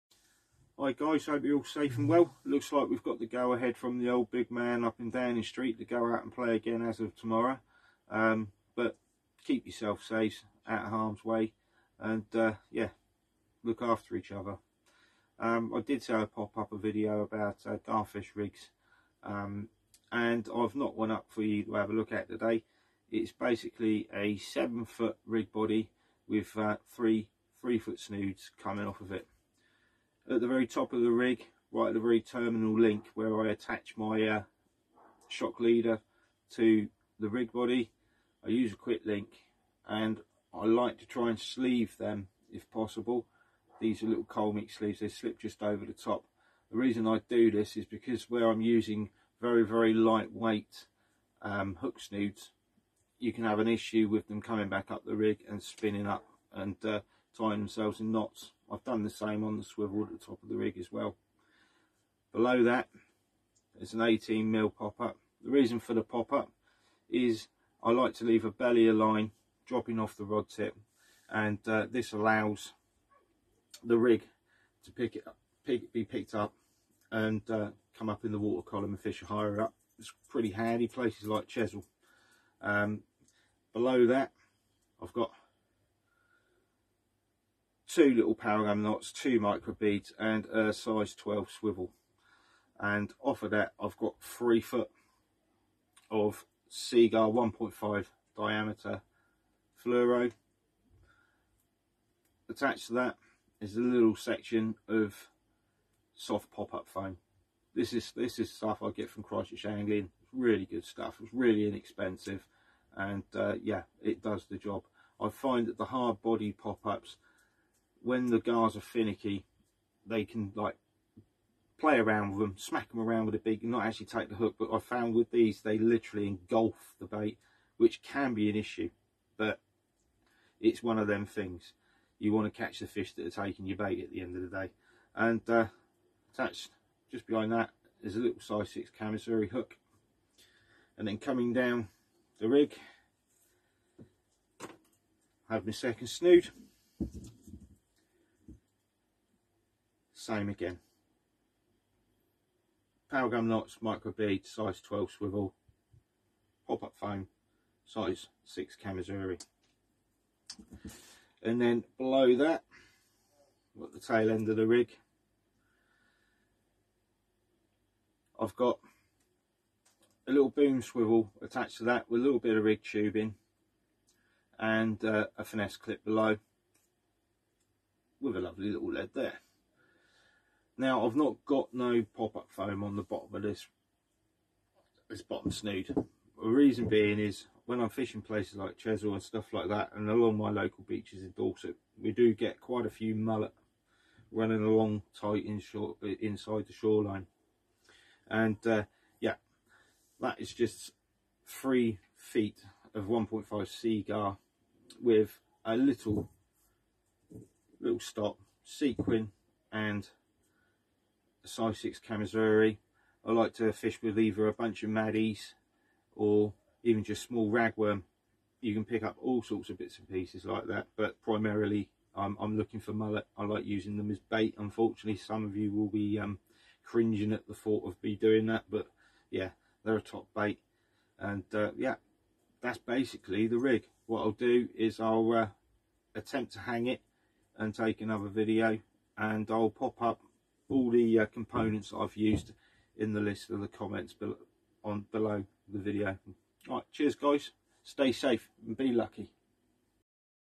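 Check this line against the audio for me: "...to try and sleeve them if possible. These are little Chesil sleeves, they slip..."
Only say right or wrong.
wrong.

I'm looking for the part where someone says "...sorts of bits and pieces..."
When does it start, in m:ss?
3:39.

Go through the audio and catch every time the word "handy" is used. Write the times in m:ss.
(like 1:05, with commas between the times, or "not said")
1:20.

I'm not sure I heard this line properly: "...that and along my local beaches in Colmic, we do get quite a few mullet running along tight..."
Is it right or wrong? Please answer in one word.
wrong.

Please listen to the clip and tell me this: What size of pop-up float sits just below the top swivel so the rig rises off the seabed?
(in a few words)
18 mil.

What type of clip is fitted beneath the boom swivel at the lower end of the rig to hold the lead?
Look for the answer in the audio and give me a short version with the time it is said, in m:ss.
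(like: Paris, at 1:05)
finesse clip, at 2:55.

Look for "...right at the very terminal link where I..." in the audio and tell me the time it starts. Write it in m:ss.
0:31.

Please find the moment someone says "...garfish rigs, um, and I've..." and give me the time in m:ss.
0:17.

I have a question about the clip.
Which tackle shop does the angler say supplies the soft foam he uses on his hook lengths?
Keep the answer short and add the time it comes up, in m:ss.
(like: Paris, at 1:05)
Christchurch Angling, at 1:49.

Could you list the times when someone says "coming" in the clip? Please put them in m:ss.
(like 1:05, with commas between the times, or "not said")
0:28, 0:54, 2:21.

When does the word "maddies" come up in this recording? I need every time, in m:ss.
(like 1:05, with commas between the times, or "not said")
3:34.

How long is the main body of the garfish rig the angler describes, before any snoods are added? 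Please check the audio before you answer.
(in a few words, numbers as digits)
7 foot.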